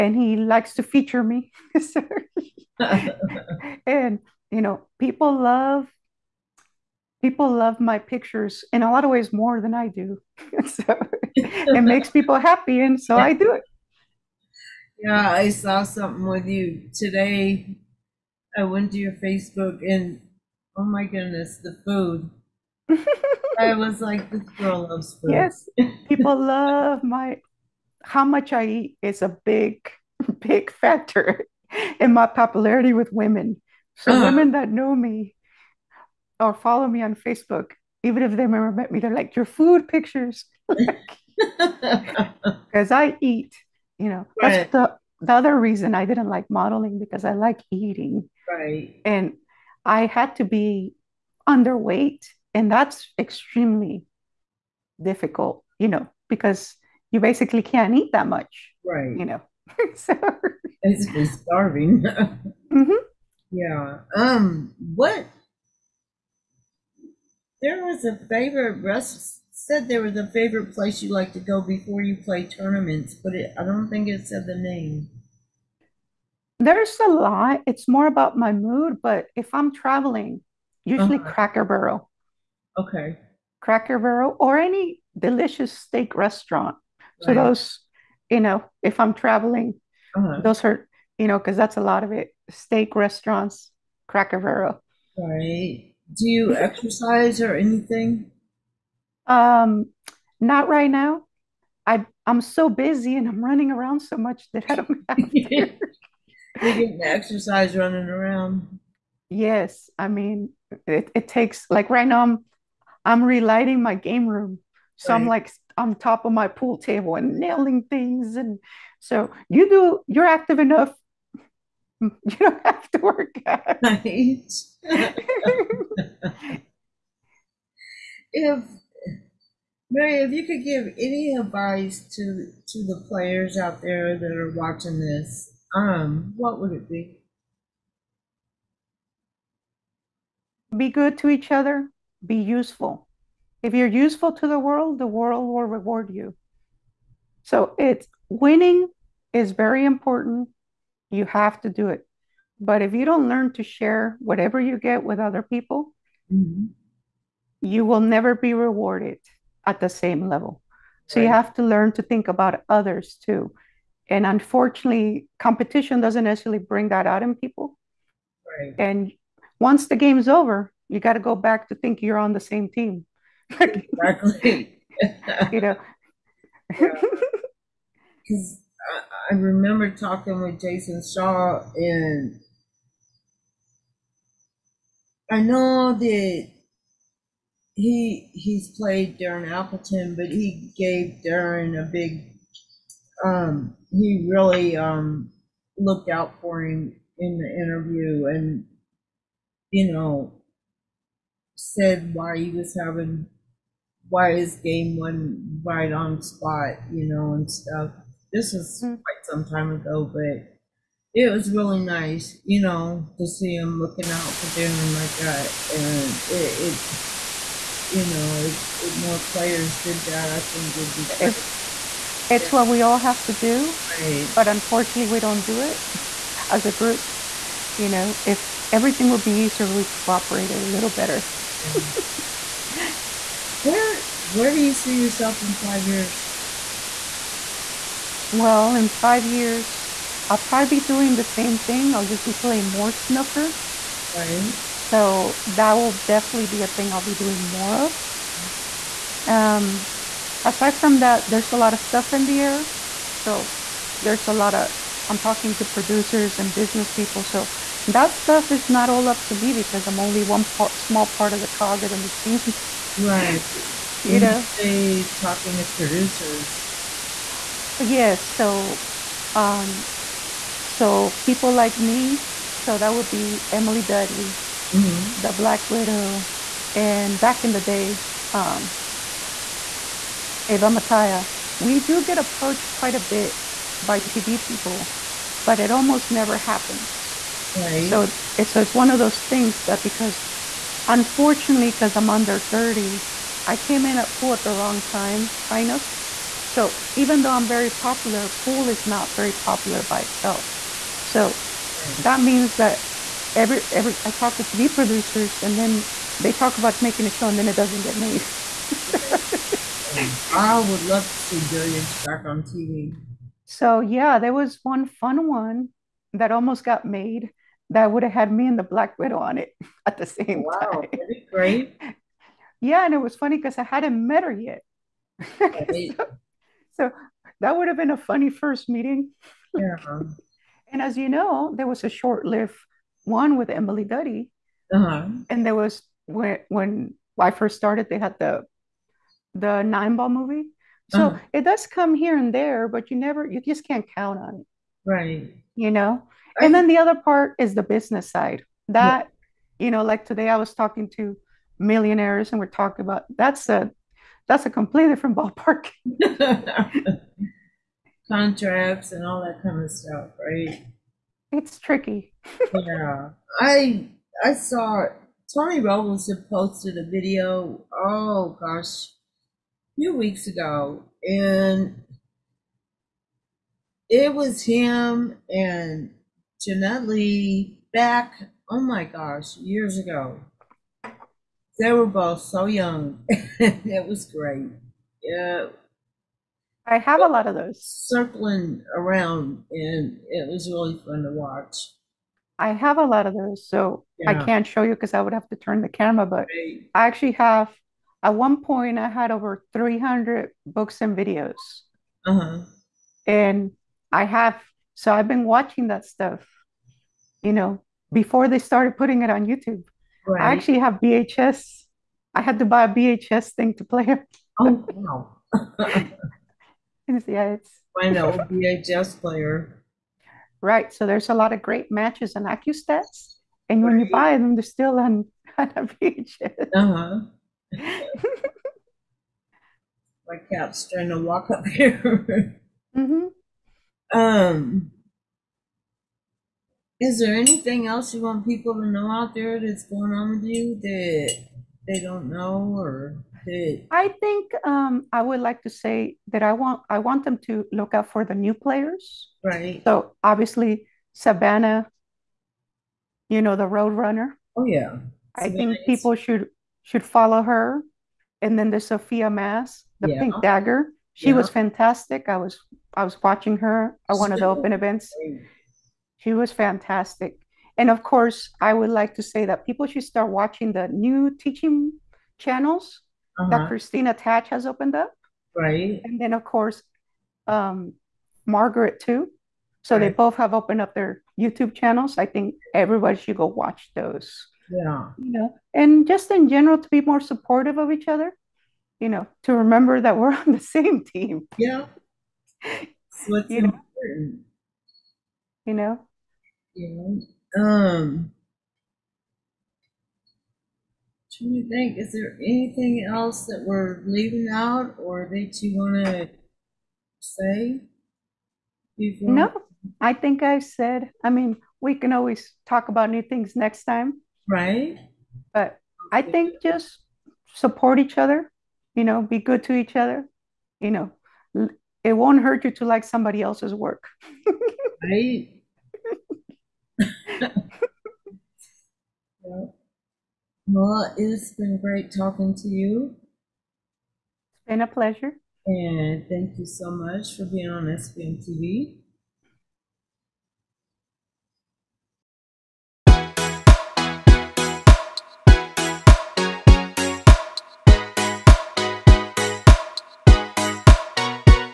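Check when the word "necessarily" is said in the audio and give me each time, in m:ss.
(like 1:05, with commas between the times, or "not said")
2:46.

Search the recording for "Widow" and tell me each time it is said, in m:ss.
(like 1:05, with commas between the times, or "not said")
4:35, 5:18.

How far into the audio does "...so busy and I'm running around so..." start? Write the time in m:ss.
1:42.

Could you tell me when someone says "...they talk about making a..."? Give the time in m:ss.
5:06.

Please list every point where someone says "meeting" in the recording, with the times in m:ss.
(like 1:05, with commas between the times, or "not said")
5:28.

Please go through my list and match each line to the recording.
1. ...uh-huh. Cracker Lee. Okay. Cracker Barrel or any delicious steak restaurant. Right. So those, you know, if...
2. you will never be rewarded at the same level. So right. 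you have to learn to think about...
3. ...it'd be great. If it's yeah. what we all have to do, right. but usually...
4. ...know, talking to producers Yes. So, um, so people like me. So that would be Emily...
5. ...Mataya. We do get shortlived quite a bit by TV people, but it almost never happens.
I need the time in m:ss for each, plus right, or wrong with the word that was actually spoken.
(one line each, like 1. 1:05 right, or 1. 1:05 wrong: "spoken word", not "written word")
1. 1:21 wrong: "Barrel", not "Lee"
2. 2:37 right
3. 3:40 wrong: "unfortunately", not "usually"
4. 4:24 right
5. 4:40 wrong: "approached", not "shortlived".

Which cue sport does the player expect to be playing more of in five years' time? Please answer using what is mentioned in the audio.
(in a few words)
Snooker.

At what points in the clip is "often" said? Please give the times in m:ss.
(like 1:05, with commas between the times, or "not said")
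not said.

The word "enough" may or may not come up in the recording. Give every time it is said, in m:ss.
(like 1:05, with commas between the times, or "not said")
2:00.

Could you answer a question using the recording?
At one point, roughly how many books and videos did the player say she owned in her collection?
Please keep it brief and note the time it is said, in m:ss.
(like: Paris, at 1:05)
Over 300, at 6:39.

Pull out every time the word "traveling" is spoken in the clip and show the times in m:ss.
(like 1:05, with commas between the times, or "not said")
1:19, 1:29.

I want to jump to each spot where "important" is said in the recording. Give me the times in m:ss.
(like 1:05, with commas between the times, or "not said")
2:29, 8:13.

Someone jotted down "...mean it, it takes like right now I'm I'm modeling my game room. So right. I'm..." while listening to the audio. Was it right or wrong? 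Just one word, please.
wrong.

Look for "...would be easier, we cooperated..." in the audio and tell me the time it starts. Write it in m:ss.
3:49.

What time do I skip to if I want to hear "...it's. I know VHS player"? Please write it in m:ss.
6:57.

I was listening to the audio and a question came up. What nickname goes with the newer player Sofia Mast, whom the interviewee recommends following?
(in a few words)
Pink Dagger.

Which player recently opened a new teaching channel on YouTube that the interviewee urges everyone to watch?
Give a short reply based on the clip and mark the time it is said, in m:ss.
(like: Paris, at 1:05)
Kristina Tkach, at 7:53.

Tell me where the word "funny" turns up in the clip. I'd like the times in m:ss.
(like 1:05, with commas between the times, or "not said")
5:23, 5:27.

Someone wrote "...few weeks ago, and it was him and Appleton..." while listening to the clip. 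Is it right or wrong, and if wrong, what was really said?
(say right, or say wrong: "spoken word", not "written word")
wrong: "Jeanette", not "Appleton".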